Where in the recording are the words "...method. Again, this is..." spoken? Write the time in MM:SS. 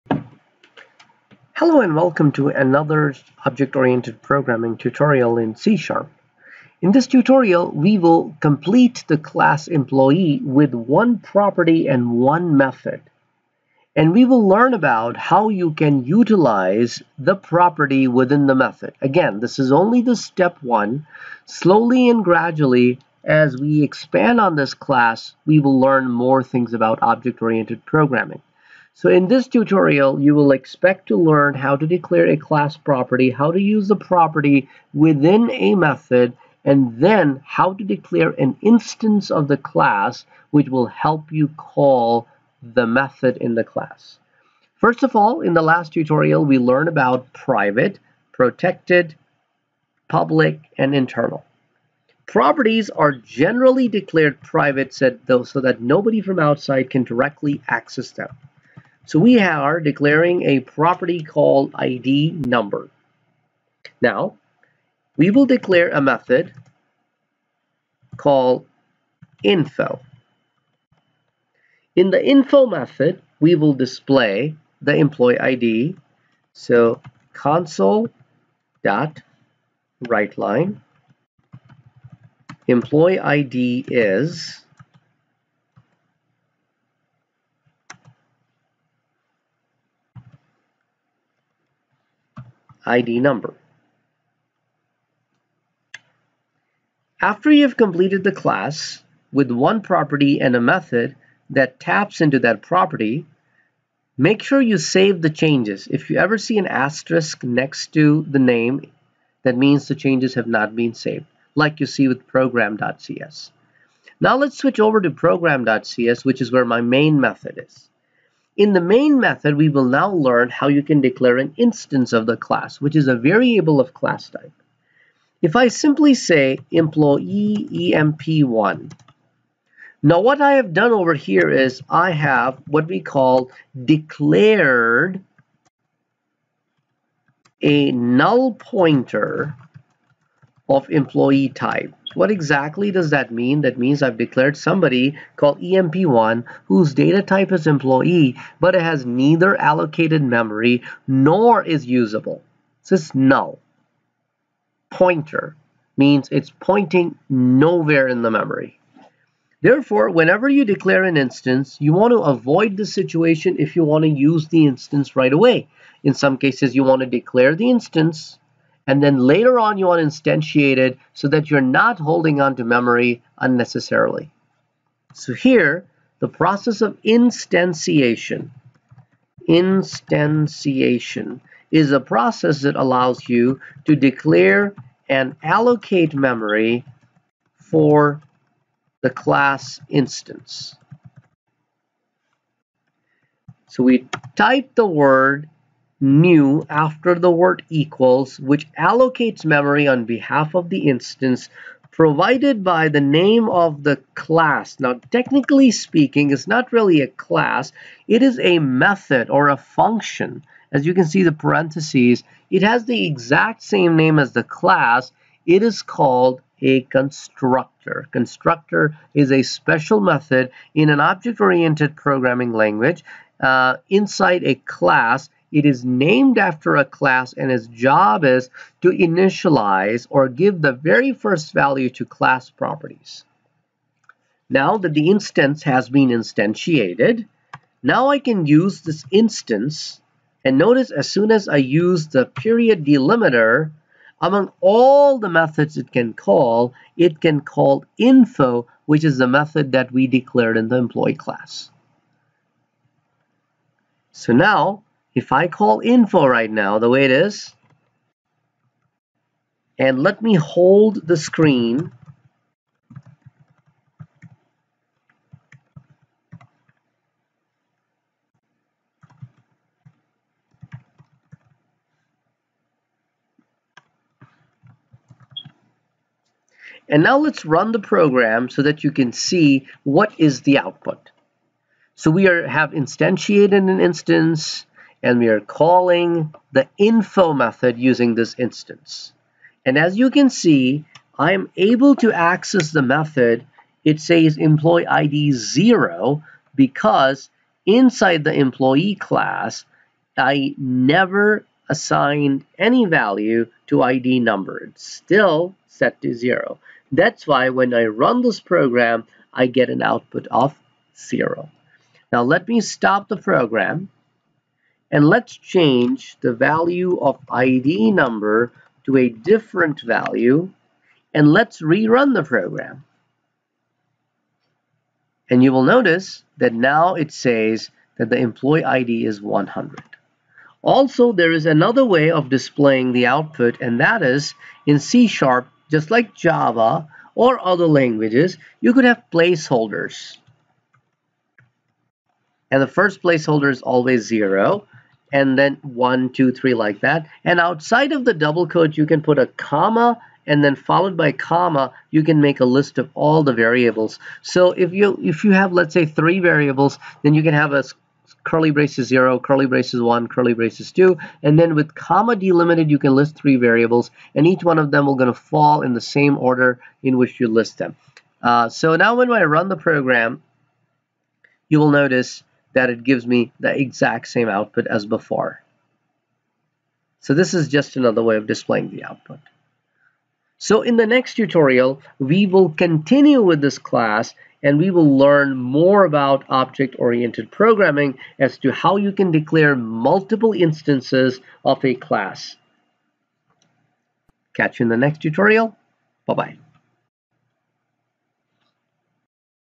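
00:18.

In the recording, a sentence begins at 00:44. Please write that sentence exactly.
First of all, in the last tutorial, we learned about private, protected, public, and internal.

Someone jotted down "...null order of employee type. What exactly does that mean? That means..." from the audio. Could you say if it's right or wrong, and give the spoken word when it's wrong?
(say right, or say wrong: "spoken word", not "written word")
wrong: "pointer", not "order".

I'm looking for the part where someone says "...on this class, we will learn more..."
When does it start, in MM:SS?
00:24.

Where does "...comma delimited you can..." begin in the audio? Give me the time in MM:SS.
06:01.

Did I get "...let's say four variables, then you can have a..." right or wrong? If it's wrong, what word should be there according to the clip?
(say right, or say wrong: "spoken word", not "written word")
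wrong: "three", not "four".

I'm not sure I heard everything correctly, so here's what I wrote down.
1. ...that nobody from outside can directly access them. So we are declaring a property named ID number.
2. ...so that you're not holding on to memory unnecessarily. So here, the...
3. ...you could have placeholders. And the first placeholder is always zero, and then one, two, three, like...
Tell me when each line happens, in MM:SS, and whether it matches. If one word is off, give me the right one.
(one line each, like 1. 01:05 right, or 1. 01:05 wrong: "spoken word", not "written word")
1. 00:55 wrong: "called", not "named"
2. 02:51 right
3. 05:38 right.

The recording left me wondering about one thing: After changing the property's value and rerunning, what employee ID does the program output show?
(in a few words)
100.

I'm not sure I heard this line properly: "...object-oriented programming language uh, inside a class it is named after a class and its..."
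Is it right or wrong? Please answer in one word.
right.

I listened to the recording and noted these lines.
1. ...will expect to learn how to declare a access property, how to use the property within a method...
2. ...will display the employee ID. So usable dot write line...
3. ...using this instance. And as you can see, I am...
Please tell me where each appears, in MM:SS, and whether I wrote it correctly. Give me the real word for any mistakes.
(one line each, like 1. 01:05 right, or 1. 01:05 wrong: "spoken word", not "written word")
1. 00:30 wrong: "class", not "access"
2. 01:13 wrong: "console", not "usable"
3. 04:47 right.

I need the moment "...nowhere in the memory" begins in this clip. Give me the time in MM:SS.
02:37.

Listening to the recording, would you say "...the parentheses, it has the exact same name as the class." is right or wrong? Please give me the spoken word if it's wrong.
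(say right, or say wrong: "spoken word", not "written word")
right.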